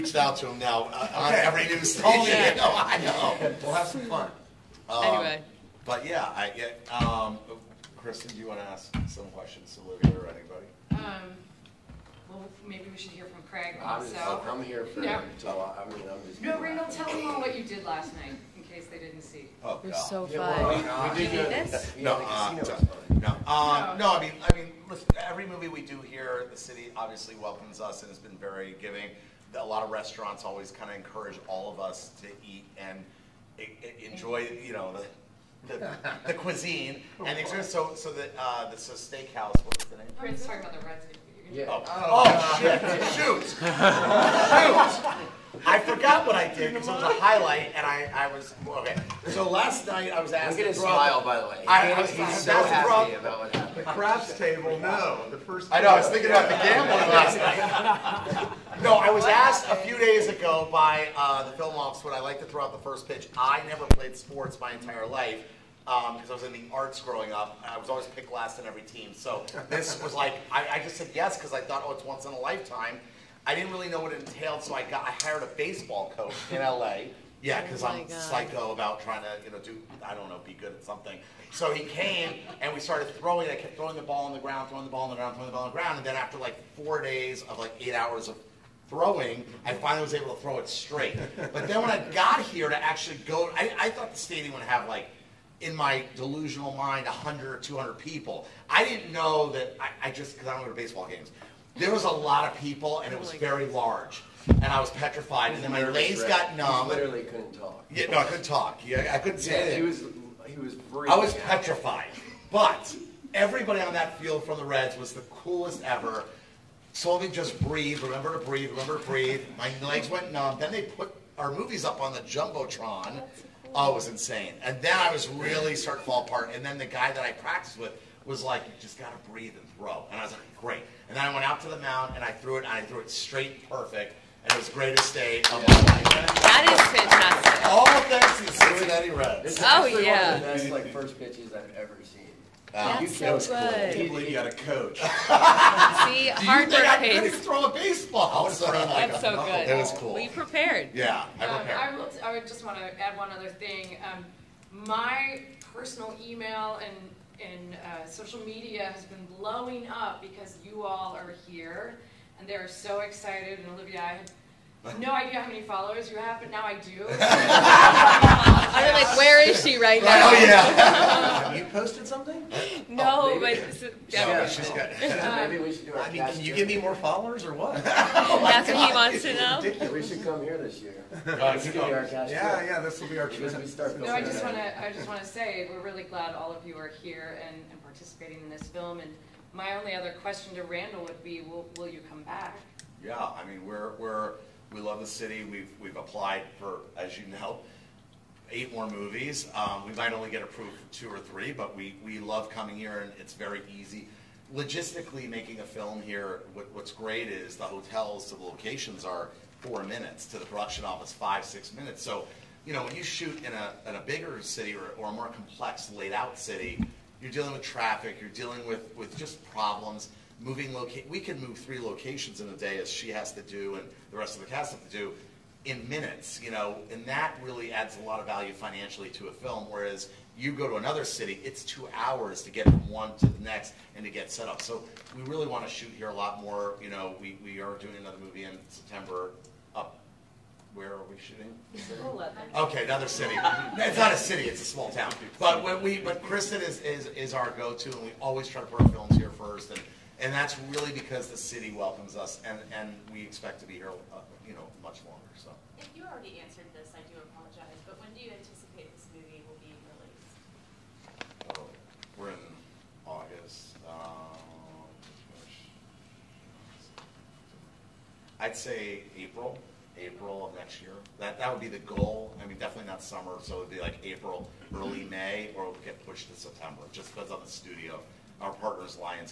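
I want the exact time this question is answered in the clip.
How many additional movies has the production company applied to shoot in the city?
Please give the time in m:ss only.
3:18.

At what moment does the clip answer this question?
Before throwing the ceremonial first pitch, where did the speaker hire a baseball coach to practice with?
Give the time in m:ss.
1:16.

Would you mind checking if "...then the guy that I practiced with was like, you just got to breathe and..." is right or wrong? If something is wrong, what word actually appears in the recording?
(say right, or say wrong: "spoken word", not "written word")
right.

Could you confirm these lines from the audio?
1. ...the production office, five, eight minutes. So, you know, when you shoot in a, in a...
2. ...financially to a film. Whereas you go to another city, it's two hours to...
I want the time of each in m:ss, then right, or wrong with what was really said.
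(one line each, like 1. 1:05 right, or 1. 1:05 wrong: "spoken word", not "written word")
1. 3:30 wrong: "six", not "eight"
2. 3:48 right.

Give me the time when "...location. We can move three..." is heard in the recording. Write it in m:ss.
3:40.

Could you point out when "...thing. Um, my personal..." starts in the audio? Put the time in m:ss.
2:33.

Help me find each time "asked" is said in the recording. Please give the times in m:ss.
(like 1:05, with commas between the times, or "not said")
0:50, 0:59.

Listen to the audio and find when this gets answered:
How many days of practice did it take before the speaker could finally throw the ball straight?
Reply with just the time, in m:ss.
1:26.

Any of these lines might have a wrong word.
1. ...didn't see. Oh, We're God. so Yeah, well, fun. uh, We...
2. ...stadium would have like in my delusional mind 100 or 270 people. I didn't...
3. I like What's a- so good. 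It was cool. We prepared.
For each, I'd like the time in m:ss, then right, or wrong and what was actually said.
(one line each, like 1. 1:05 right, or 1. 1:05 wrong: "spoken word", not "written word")
1. 0:18 right
2. 1:34 wrong: "200", not "270"
3. 2:28 wrong: "That", not "What".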